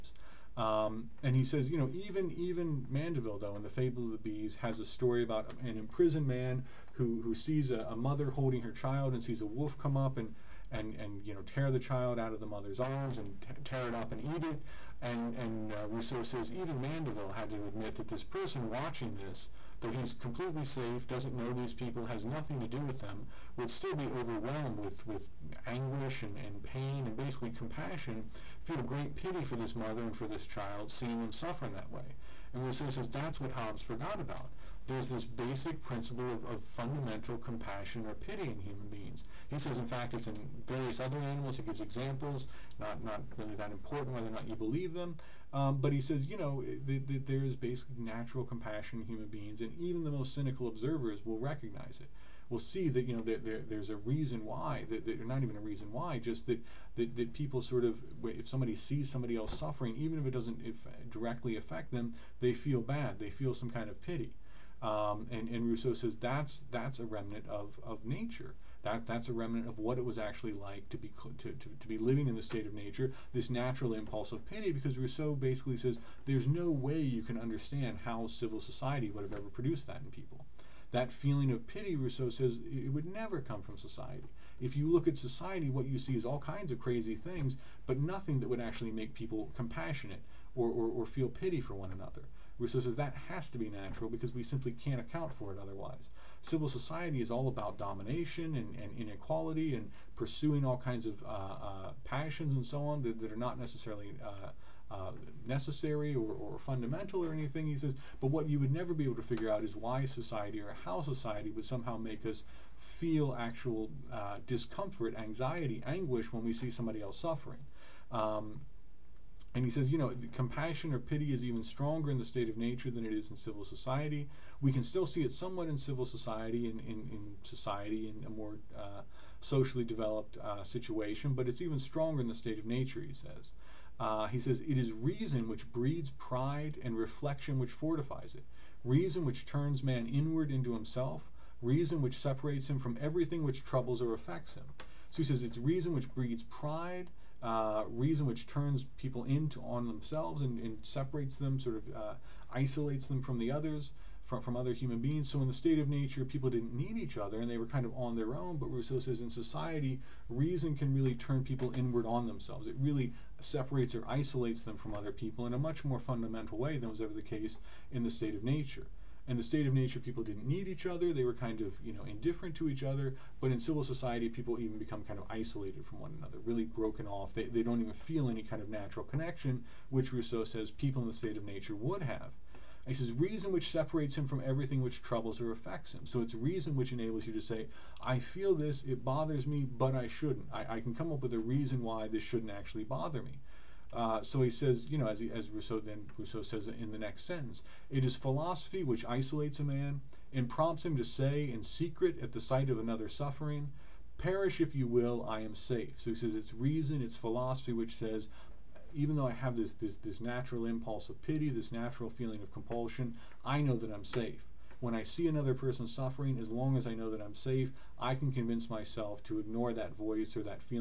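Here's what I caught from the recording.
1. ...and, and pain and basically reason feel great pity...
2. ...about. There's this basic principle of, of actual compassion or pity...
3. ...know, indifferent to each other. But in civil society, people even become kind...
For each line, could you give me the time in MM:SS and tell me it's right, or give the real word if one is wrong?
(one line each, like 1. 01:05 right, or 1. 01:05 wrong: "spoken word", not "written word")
1. 00:26 wrong: "compassion", not "reason"
2. 00:34 wrong: "fundamental", not "actual"
3. 02:51 right.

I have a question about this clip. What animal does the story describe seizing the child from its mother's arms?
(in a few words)
wolf.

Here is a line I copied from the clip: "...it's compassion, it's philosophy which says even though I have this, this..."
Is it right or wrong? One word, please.
wrong.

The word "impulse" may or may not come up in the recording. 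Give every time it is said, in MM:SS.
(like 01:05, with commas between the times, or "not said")
01:13, 03:30.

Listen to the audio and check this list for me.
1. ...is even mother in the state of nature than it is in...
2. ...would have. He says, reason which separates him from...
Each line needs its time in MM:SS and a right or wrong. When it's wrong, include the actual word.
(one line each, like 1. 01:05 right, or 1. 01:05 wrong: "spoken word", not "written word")
1. 02:01 wrong: "stronger", not "mother"
2. 03:01 right.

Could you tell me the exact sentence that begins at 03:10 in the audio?
I, I can come up with a reason why this shouldn't actually bother me.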